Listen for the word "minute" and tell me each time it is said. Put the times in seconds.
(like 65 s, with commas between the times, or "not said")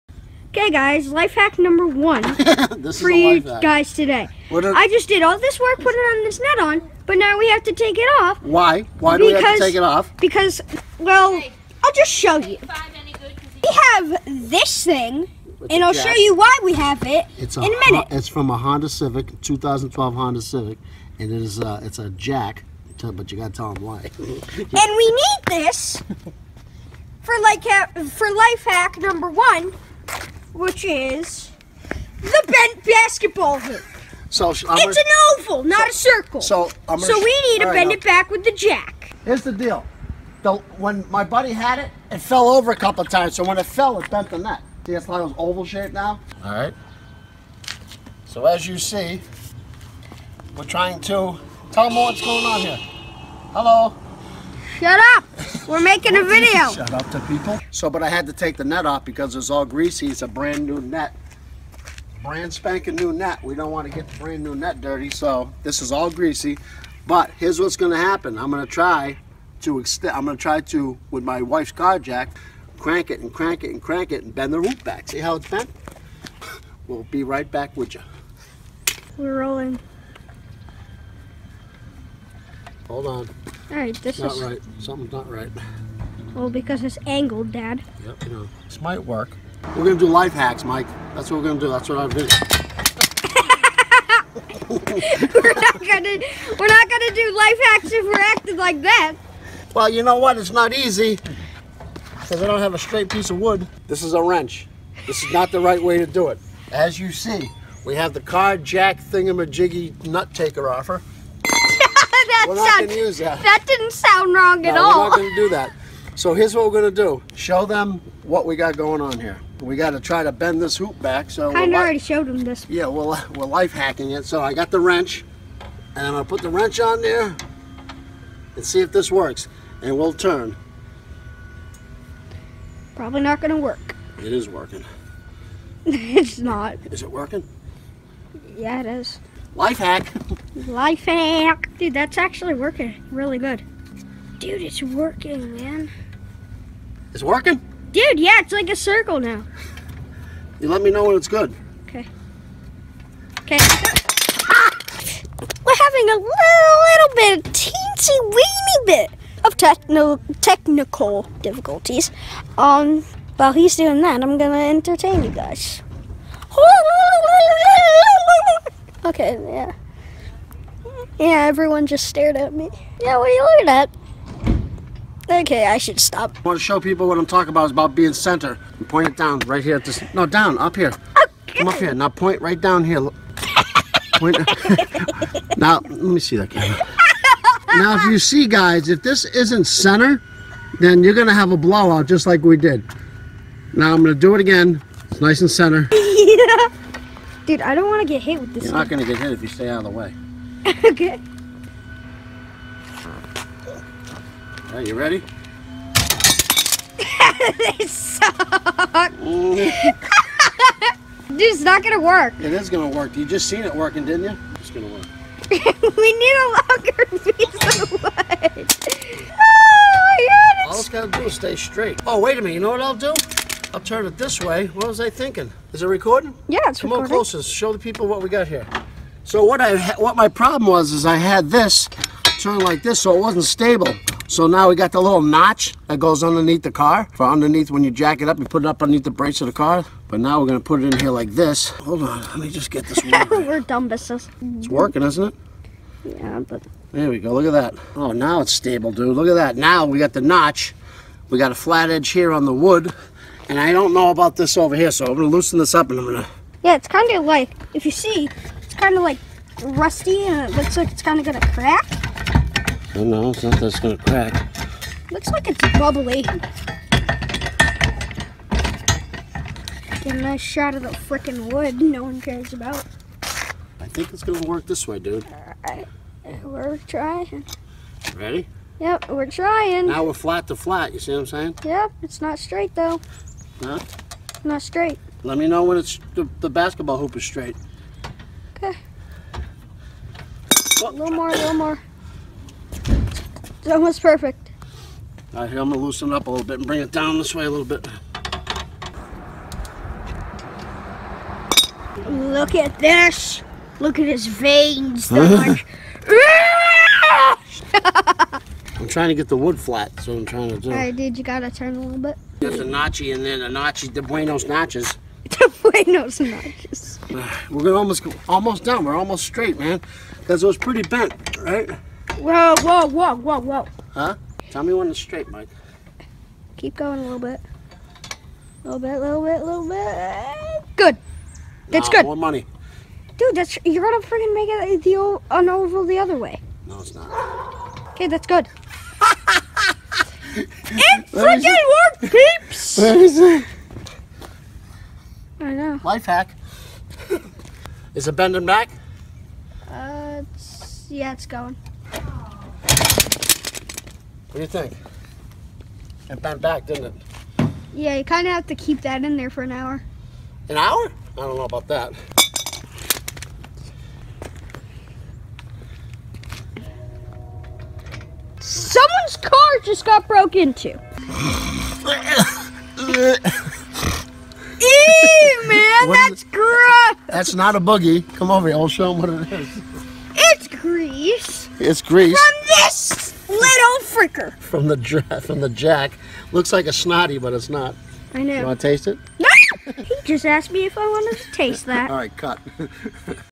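17 s, 222 s.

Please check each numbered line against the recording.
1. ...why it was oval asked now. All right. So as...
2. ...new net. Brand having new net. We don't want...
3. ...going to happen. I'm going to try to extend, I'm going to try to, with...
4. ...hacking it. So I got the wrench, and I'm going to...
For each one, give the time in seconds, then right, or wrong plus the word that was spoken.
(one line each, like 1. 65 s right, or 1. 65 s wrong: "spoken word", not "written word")
1. 45 s wrong: "shaped", not "asked"
2. 60 s wrong: "spanking", not "having"
3. 67 s right
4. 123 s right.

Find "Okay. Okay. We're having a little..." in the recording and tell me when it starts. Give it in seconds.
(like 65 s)
151 s.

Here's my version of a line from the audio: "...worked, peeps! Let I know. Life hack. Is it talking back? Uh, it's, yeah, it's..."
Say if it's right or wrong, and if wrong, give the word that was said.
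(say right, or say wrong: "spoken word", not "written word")
wrong: "bending", not "talking".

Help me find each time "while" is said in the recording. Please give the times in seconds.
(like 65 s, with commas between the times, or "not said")
163 s.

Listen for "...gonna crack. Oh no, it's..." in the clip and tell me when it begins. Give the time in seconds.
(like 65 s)
261 s.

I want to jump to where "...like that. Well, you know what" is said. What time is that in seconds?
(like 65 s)
98 s.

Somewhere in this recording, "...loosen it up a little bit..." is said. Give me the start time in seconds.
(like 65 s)
295 s.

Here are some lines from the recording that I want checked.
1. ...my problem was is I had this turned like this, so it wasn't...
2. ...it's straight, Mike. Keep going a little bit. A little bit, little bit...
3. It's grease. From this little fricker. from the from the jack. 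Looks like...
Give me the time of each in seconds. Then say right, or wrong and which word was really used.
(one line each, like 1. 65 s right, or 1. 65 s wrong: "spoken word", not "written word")
1. 230 s right
2. 324 s right
3. 381 s right.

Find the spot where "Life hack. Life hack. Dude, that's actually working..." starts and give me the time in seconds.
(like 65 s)
139 s.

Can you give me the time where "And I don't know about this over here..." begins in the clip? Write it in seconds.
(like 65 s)
253 s.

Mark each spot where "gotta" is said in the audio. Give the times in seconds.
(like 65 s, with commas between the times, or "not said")
23 s, 311 s.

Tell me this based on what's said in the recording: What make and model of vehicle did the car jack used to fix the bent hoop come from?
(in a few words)
2012 Honda Civic.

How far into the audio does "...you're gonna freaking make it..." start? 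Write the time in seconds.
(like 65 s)
333 s.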